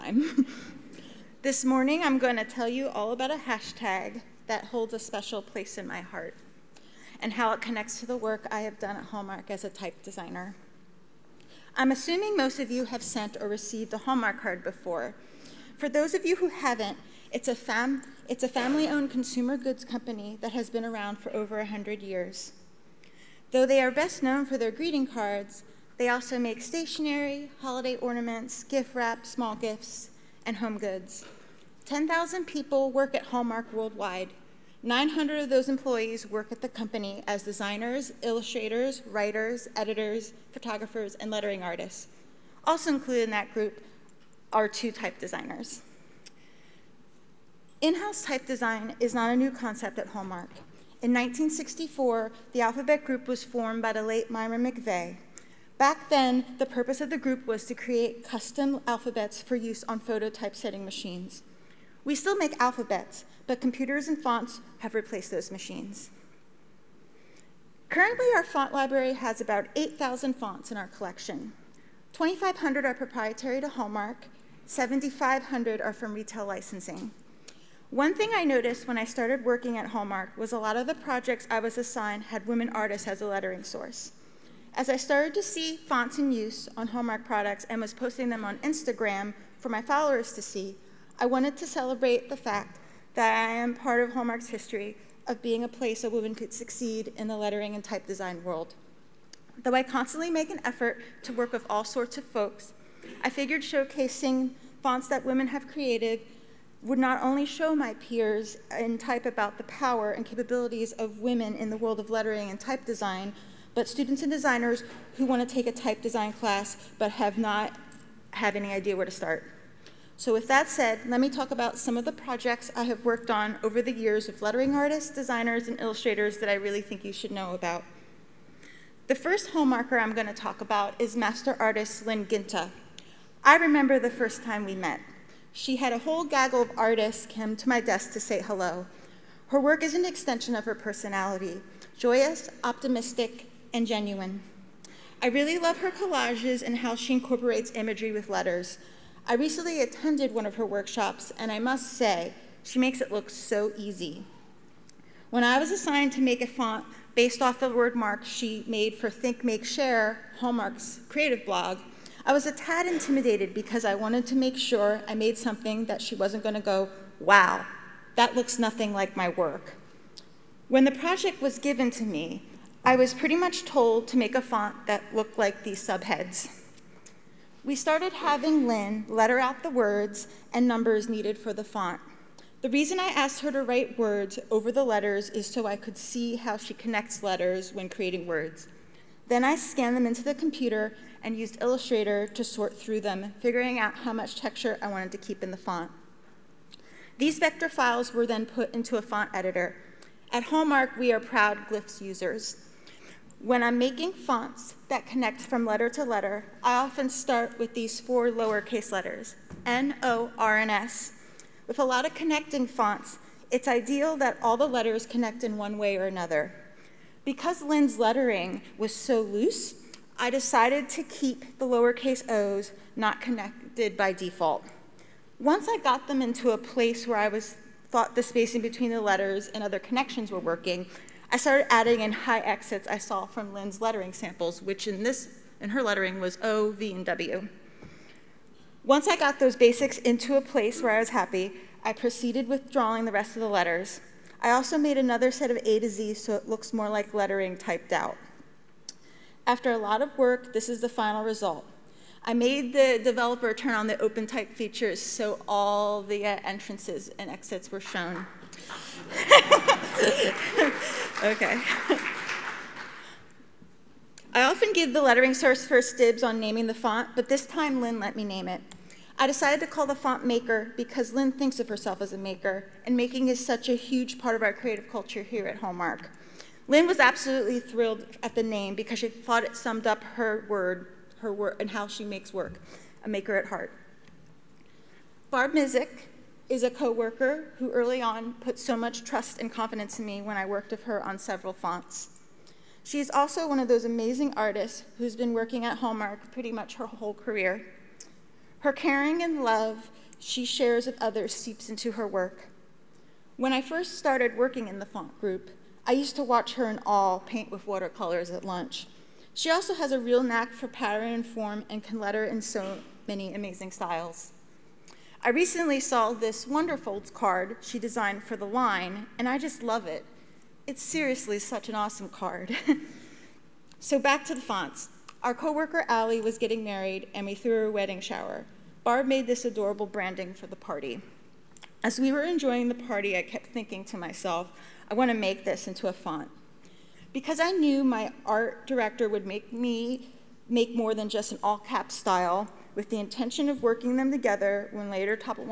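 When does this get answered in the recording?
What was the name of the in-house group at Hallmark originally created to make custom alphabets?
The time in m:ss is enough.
0:52.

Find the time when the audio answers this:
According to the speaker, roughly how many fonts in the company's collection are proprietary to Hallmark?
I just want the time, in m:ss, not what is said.
1:12.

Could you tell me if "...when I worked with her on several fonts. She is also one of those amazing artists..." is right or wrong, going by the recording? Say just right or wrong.
right.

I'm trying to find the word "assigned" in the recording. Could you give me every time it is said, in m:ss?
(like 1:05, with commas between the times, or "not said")
1:21, 2:35.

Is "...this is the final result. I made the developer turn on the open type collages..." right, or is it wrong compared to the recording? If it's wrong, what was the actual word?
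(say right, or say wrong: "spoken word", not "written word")
wrong: "features", not "collages".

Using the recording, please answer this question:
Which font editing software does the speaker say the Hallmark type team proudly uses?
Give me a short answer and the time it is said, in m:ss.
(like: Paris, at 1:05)
Glyphs, at 3:21.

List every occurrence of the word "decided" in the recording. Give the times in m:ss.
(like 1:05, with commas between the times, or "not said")
3:40, 4:29.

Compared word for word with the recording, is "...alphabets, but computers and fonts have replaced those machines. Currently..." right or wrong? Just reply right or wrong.
right.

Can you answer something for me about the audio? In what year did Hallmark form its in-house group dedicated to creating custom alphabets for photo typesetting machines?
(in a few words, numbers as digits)
1964.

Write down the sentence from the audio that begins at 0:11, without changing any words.
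I'm assuming most of you have sent or received a Hallmark card before.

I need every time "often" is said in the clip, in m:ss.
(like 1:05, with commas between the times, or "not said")
3:26, 4:24.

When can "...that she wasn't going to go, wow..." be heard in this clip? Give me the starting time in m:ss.
2:45.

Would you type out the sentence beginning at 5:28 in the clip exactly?
Barb made this adorable branding for the party.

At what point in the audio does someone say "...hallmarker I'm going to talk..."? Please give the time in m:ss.
2:09.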